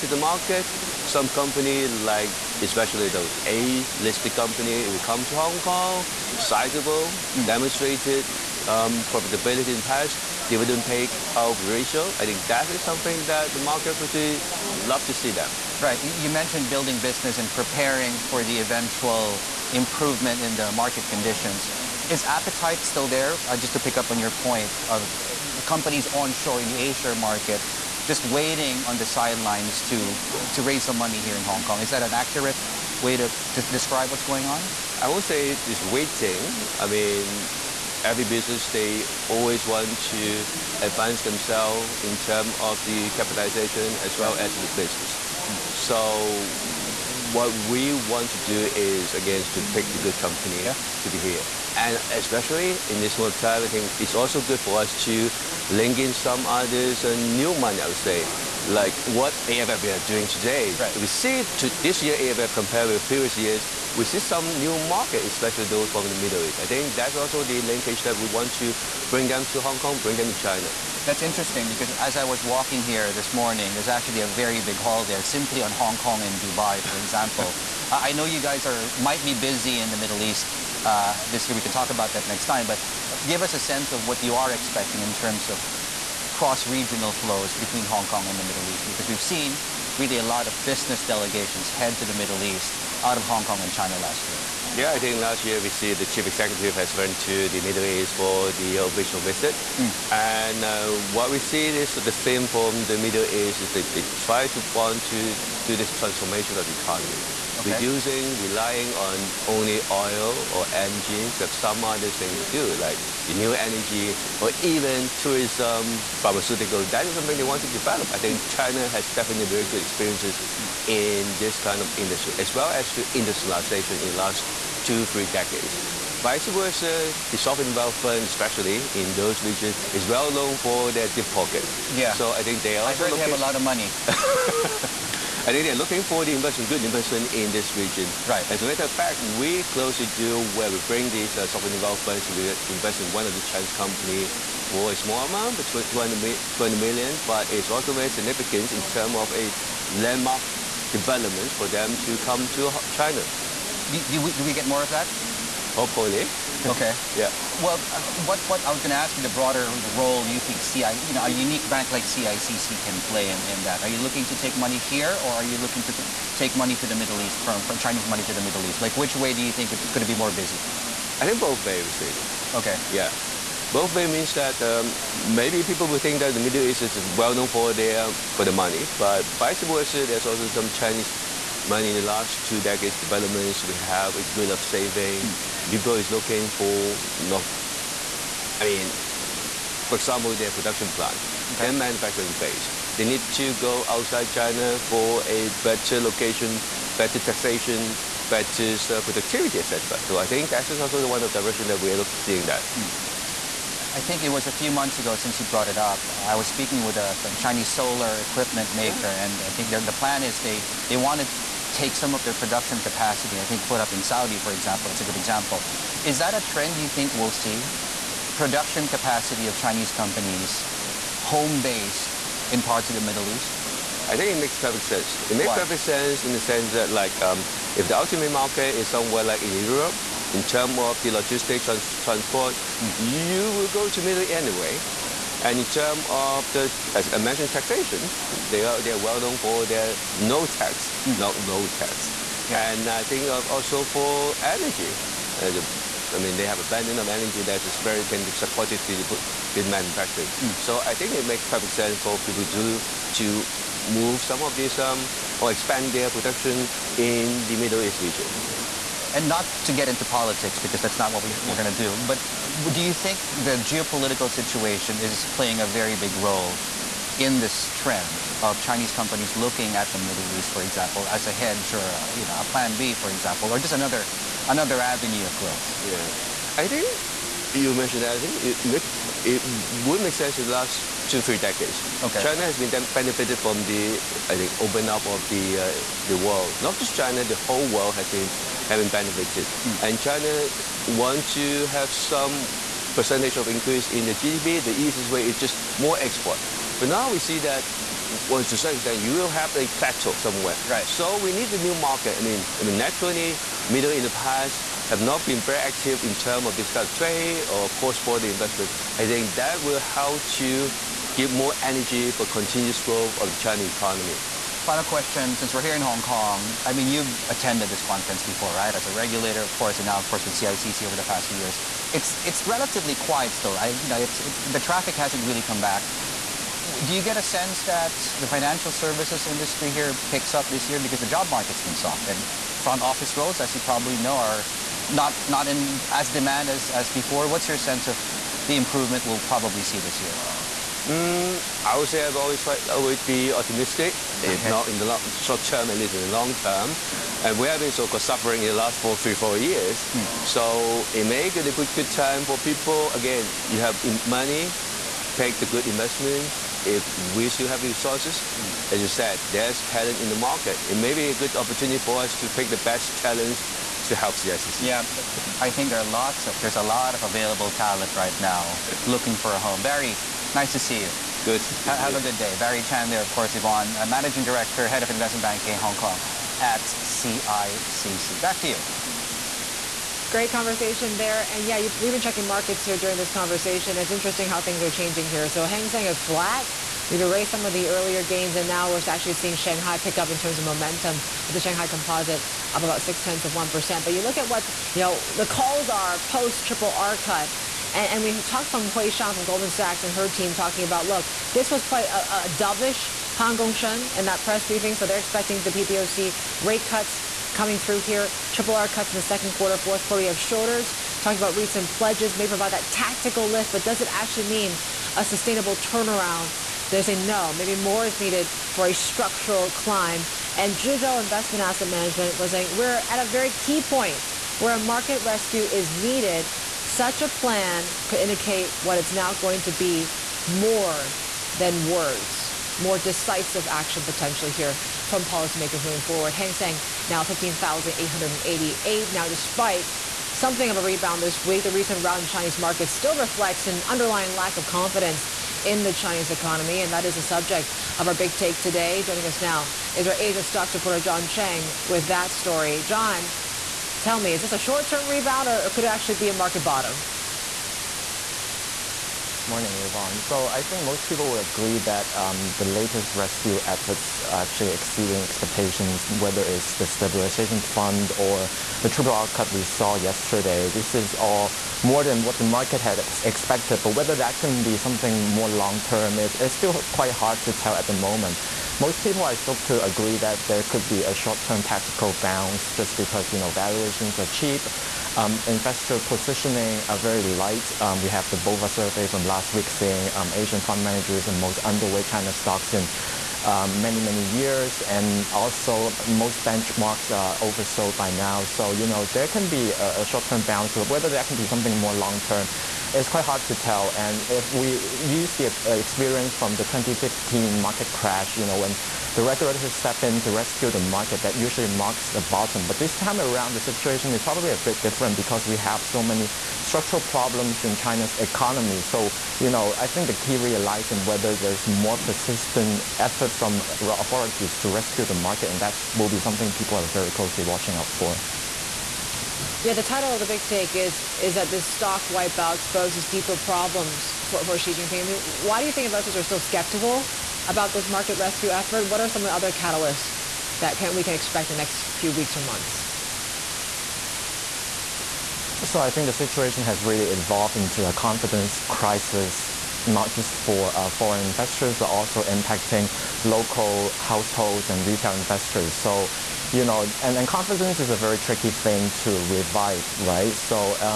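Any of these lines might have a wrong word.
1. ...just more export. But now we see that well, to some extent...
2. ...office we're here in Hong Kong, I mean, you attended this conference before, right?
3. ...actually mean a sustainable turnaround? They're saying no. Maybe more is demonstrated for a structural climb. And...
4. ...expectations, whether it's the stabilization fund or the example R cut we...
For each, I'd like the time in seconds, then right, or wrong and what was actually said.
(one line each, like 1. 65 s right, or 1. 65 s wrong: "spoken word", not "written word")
1. 295 s right
2. 315 s wrong: "since", not "office"
3. 413 s wrong: "needed", not "demonstrated"
4. 465 s wrong: "triple", not "example".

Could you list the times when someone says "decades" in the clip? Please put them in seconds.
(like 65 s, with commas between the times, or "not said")
125 s, 182 s, 281 s.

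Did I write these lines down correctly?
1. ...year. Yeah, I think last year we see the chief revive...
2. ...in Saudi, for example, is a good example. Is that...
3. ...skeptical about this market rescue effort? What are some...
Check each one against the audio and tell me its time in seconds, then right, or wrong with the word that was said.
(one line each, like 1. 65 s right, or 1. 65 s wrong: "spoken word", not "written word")
1. 94 s wrong: "executive", not "revive"
2. 213 s right
3. 536 s right.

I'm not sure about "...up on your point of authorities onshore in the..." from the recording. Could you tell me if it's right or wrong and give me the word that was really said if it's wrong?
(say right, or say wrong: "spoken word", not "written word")
wrong: "companies", not "authorities".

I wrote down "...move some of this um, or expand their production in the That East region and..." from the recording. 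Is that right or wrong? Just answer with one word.
wrong.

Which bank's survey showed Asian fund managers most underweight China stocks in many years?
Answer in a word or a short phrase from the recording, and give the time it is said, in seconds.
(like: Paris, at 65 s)
BofA, at 488 s.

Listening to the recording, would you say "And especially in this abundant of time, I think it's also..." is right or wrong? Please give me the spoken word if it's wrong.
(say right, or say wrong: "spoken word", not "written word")
wrong: "moment", not "abundant".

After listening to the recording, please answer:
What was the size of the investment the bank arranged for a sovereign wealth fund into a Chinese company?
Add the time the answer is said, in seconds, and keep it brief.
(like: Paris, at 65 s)
200 million, at 146 s.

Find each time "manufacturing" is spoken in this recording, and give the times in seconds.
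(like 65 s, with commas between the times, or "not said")
191 s, 249 s.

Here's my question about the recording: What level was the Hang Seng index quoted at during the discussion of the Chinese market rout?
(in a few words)
15,888.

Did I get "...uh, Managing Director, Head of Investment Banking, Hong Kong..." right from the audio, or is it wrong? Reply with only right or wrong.
right.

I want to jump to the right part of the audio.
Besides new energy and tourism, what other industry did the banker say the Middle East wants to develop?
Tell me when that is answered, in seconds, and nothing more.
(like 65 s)
116 s.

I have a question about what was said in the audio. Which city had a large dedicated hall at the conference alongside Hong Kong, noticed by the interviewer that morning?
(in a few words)
Dubai.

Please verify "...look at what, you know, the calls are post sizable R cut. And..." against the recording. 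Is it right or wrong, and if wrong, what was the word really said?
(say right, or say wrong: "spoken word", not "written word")
wrong: "triple", not "sizable".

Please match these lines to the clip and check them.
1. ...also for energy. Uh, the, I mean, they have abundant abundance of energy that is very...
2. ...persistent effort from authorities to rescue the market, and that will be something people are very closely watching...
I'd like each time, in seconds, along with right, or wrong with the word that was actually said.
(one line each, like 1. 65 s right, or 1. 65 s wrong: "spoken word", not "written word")
1. 243 s right
2. 521 s right.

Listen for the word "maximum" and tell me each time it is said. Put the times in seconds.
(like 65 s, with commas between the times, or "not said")
not said.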